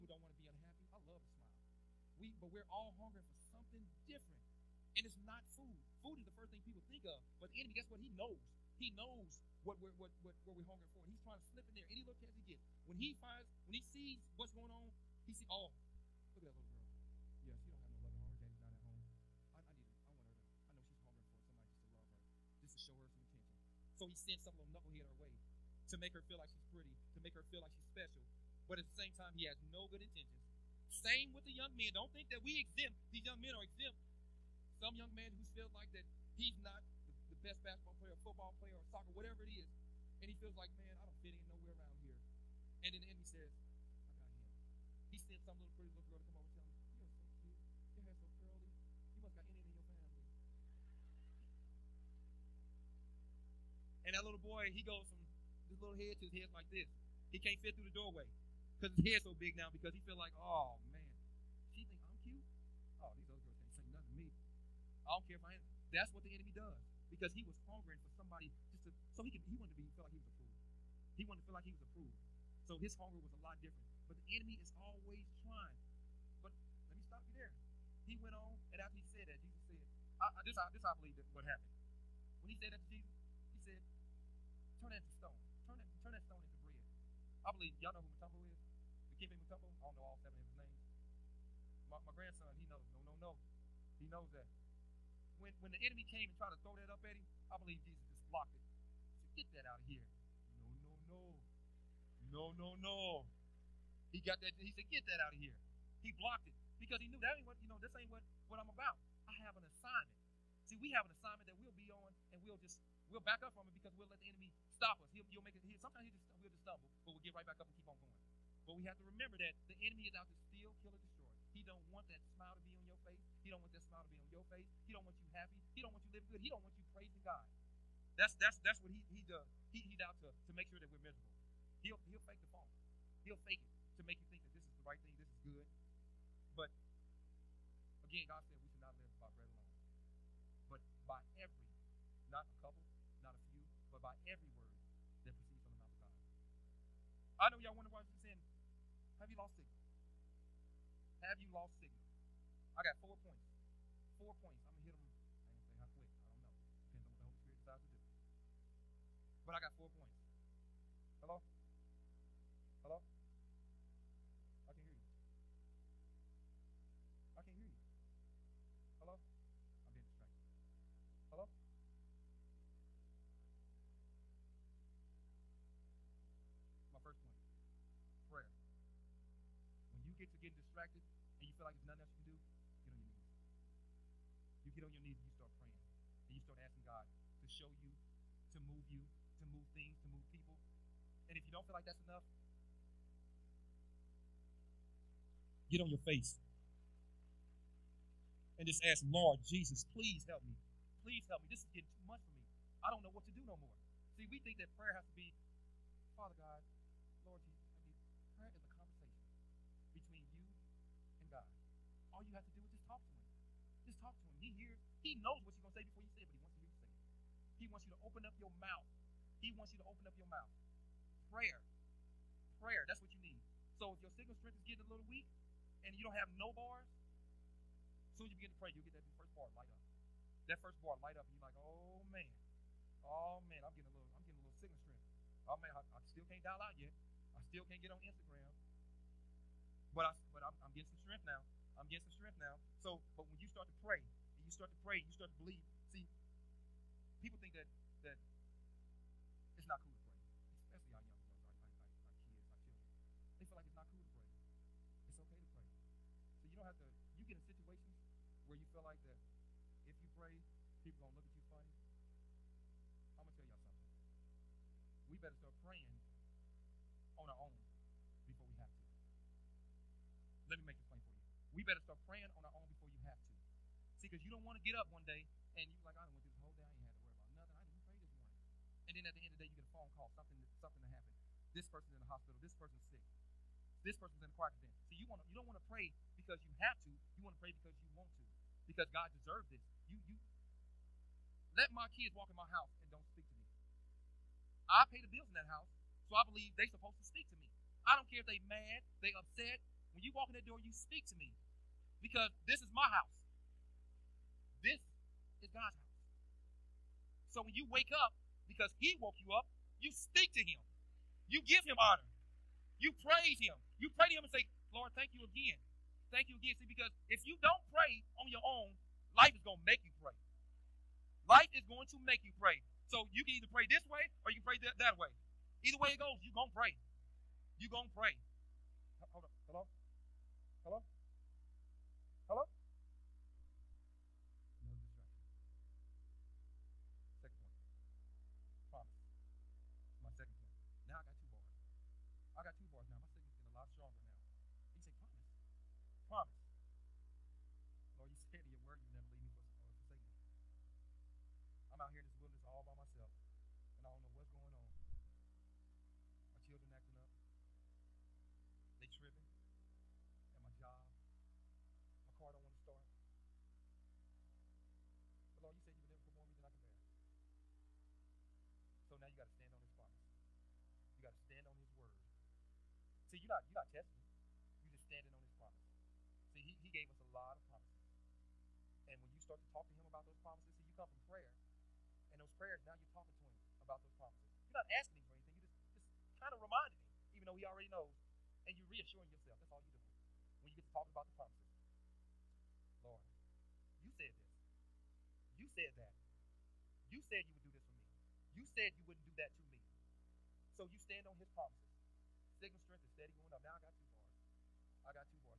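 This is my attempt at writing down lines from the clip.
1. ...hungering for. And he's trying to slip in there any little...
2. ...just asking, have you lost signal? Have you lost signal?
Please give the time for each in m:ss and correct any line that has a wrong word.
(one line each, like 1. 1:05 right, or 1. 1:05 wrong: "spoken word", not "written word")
1. 0:10 right
2. 2:28 wrong: "saying", not "asking".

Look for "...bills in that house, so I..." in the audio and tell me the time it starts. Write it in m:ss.
4:55.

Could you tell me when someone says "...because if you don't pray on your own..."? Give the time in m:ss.
5:16.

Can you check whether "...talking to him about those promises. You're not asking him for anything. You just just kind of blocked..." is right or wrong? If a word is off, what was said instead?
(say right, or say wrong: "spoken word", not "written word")
wrong: "reminded", not "blocked".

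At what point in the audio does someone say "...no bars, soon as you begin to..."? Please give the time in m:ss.
3:46.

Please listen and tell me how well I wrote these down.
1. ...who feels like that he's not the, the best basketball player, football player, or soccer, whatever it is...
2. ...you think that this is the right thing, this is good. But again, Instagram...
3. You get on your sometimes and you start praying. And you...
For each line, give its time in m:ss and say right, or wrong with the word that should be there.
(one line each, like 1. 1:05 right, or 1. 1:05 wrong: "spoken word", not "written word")
1. 0:35 right
2. 2:14 wrong: "God", not "Instagram"
3. 3:04 wrong: "knees", not "sometimes".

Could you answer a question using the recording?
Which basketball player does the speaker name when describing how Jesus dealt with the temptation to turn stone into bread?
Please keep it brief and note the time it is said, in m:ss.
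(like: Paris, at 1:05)
Dikembe Mutombo, at 1:29.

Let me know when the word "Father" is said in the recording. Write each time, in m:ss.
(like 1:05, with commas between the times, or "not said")
3:26.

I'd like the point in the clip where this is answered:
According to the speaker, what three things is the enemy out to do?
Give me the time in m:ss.
2:00.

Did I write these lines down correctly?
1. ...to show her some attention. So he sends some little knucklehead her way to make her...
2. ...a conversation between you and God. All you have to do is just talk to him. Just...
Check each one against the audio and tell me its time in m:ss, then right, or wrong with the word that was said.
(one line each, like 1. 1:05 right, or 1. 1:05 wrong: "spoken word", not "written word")
1. 0:22 right
2. 3:28 right.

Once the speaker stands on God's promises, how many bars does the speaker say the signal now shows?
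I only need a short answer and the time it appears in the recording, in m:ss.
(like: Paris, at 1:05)
2, at 6:43.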